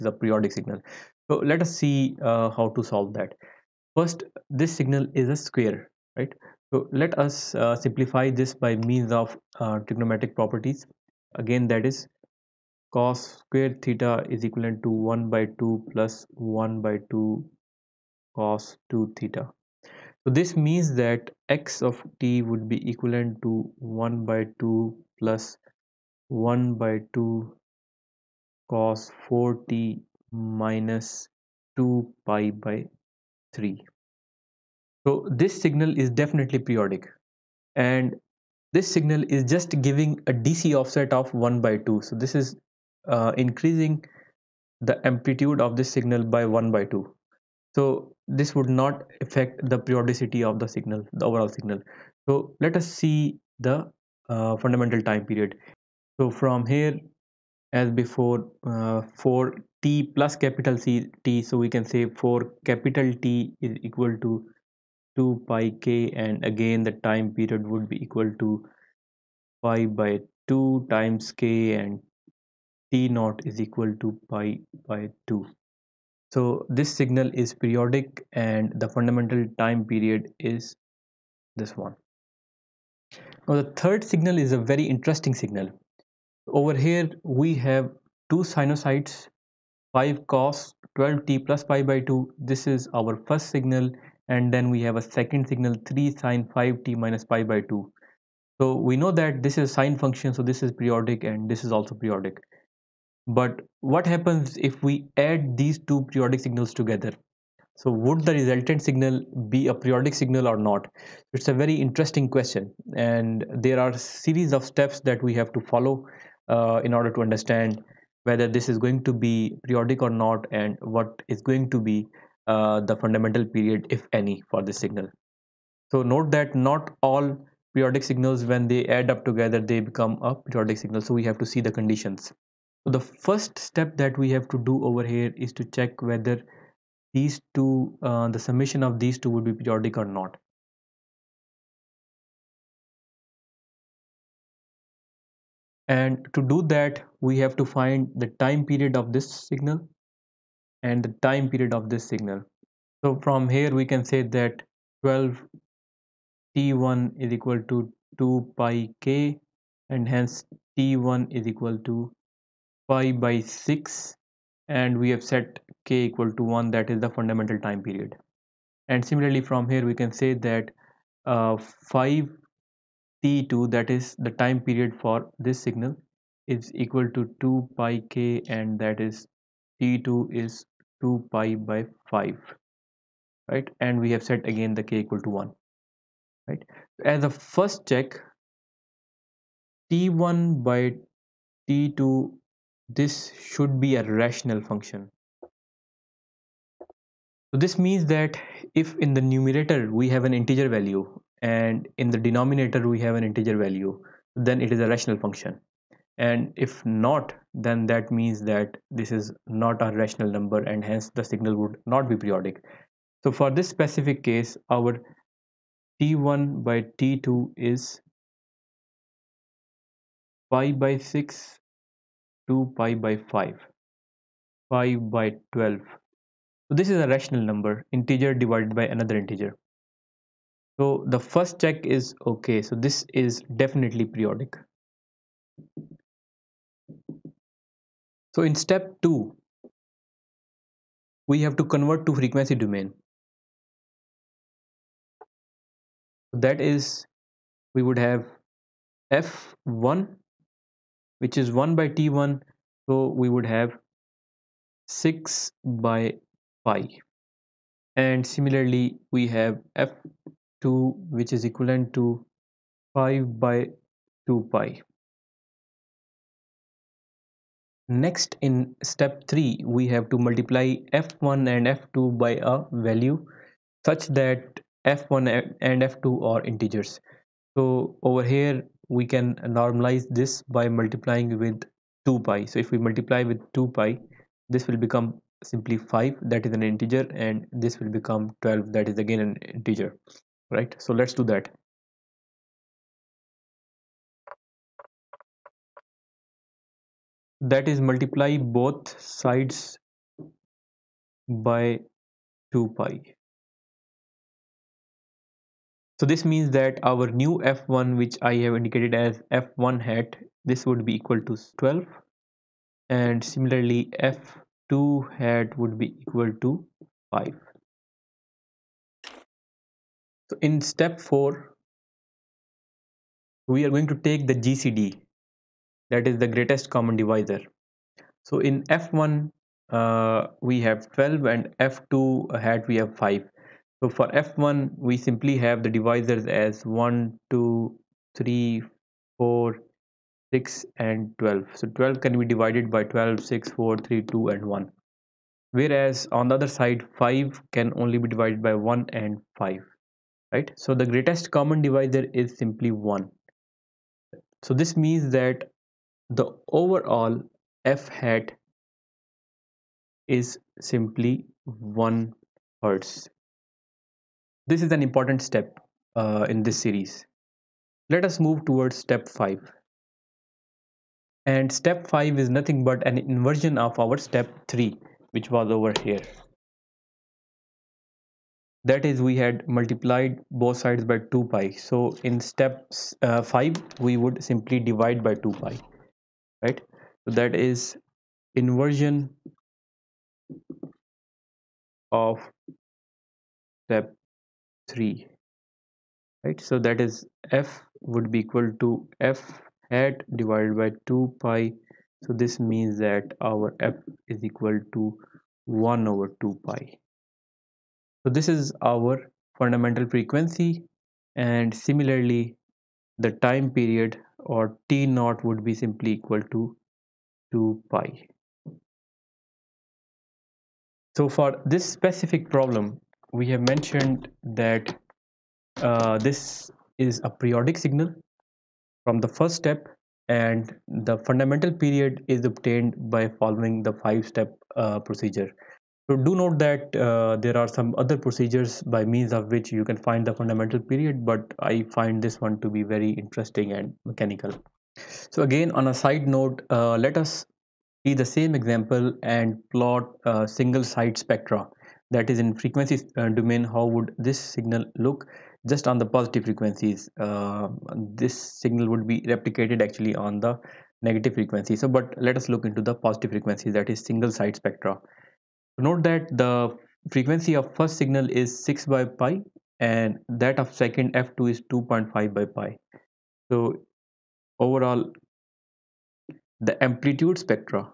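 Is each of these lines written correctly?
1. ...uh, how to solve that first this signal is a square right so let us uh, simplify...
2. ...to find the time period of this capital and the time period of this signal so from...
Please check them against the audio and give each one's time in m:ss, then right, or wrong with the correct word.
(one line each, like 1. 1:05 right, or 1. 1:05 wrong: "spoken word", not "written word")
1. 0:02 right
2. 2:27 wrong: "signal", not "capital".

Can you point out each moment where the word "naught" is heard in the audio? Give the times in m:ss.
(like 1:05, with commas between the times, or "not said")
1:13, 6:54.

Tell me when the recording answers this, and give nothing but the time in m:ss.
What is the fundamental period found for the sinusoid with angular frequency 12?
2:40.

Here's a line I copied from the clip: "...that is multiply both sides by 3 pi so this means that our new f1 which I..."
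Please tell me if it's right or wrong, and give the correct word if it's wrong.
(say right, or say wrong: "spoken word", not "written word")
wrong: "2", not "3".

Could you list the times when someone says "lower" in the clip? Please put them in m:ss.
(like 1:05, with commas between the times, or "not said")
not said.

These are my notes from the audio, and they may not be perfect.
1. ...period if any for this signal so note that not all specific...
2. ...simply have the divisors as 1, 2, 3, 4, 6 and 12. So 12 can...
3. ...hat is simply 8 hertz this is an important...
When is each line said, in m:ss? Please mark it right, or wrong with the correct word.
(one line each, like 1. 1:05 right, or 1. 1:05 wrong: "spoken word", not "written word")
1. 2:03 wrong: "periodic", not "specific"
2. 5:34 right
3. 5:57 wrong: "1", not "8".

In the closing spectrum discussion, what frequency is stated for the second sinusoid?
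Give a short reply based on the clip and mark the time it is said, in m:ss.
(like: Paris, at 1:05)
2.5/pi, at 7:51.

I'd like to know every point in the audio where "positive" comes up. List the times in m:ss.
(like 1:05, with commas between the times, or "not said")
7:35, 7:42.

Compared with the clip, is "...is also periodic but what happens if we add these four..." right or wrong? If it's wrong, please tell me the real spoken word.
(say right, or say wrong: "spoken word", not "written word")
wrong: "two", not "four".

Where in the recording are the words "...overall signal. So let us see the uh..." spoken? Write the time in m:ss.
0:51.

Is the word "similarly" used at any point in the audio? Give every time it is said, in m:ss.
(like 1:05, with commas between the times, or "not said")
2:49, 4:18, 5:13, 6:51.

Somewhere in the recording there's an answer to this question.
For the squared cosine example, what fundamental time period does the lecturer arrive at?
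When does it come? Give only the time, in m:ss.
1:12.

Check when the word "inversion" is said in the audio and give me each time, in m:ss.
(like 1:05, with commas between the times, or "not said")
6:13, 6:28.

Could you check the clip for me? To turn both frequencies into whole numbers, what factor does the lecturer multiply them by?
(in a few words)
2 pi.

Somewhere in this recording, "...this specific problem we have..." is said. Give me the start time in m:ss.
7:01.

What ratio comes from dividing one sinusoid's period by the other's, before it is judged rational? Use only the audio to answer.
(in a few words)
5/12.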